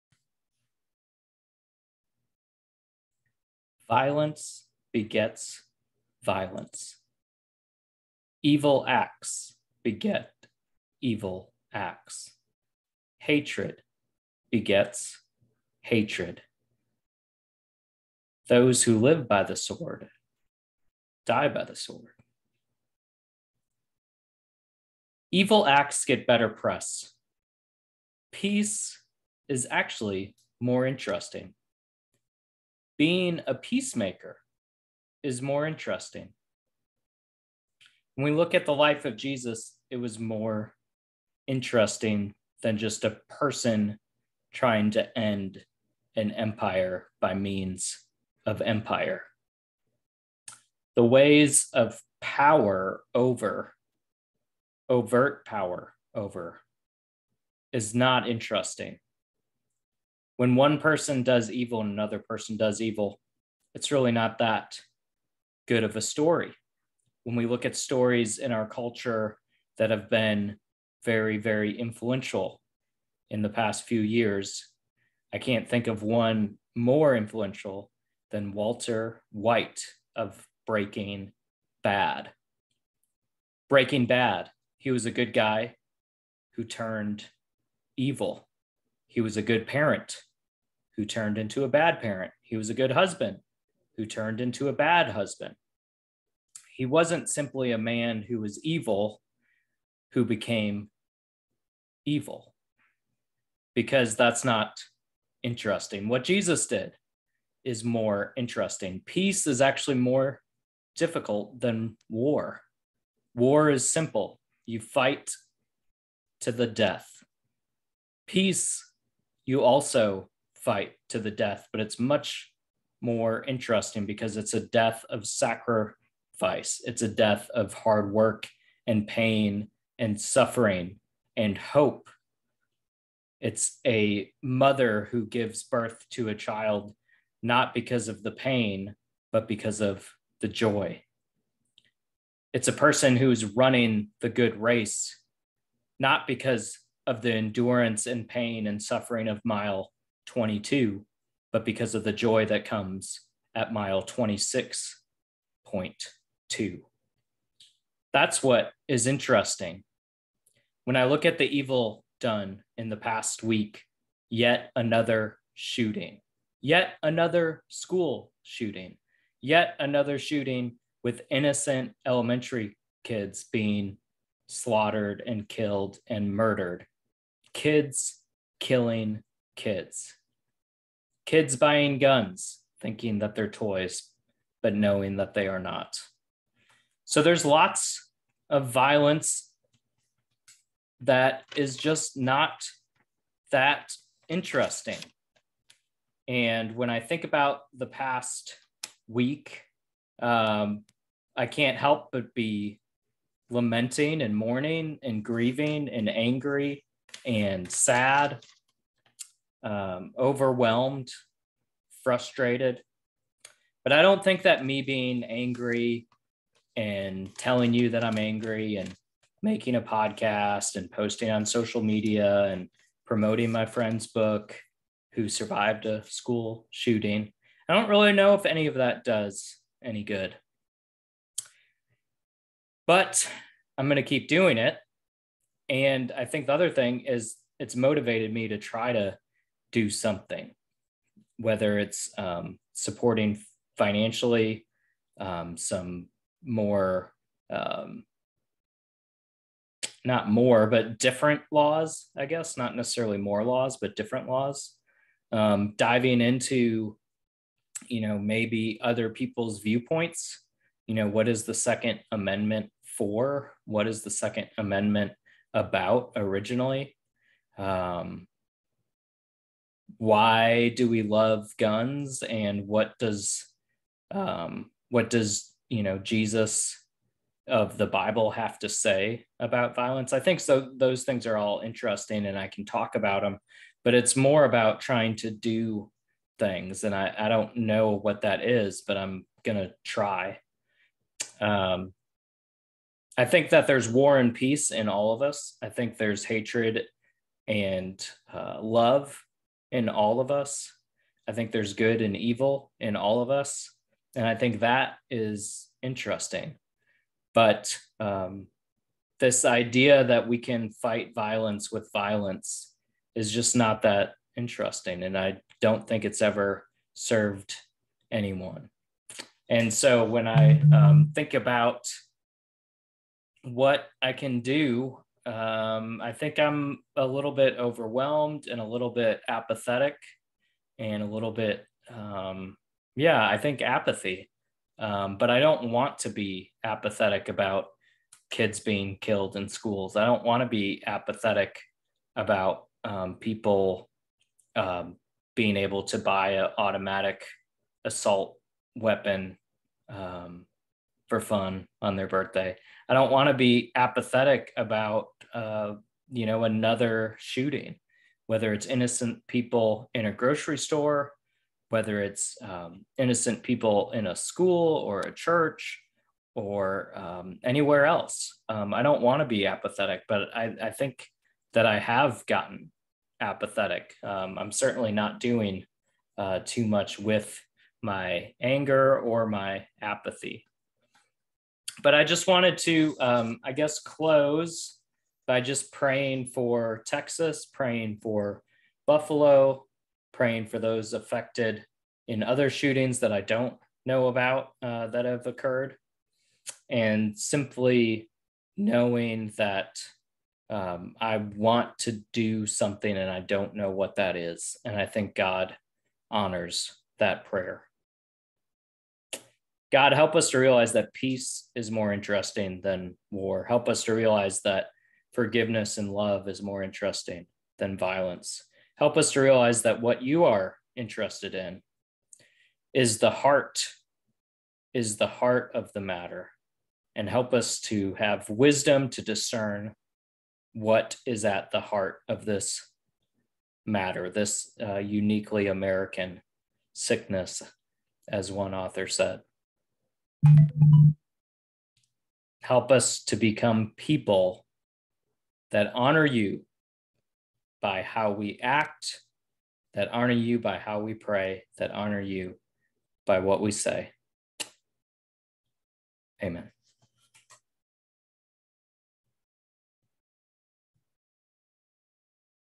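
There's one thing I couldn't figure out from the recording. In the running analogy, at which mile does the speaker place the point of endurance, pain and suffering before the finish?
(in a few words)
22.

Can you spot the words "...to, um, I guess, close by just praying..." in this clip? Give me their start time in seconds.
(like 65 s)
382 s.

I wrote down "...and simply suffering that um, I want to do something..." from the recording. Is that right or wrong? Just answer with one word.
wrong.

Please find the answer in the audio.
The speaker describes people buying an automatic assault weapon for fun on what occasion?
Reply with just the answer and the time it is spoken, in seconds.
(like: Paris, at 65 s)
their birthday, at 351 s.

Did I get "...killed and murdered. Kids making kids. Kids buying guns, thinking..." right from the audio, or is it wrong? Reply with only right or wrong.
wrong.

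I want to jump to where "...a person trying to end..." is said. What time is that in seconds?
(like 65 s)
43 s.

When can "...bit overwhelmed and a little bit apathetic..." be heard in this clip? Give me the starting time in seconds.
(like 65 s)
327 s.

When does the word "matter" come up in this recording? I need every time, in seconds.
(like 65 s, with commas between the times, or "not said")
425 s, 433 s.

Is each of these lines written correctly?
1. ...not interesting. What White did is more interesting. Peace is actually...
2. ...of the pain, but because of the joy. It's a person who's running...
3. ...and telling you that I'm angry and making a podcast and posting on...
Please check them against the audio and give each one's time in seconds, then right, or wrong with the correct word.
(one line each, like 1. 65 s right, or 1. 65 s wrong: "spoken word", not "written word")
1. 104 s wrong: "Jesus", not "White"
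2. 138 s right
3. 216 s right.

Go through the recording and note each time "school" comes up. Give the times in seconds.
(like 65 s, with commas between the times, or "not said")
167 s, 226 s, 339 s, 364 s.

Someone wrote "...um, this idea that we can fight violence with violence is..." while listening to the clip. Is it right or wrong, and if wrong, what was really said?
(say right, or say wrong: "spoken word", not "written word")
right.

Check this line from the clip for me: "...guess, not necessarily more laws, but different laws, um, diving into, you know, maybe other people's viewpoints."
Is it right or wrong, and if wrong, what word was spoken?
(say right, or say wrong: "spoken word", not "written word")
right.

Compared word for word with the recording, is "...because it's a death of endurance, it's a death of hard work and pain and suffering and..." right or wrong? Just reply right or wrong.
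wrong.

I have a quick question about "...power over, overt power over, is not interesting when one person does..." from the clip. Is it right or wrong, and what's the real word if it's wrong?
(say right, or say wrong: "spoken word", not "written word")
right.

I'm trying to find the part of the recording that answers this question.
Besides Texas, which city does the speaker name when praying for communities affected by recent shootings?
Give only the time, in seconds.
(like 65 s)
388 s.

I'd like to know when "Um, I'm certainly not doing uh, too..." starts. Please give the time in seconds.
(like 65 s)
374 s.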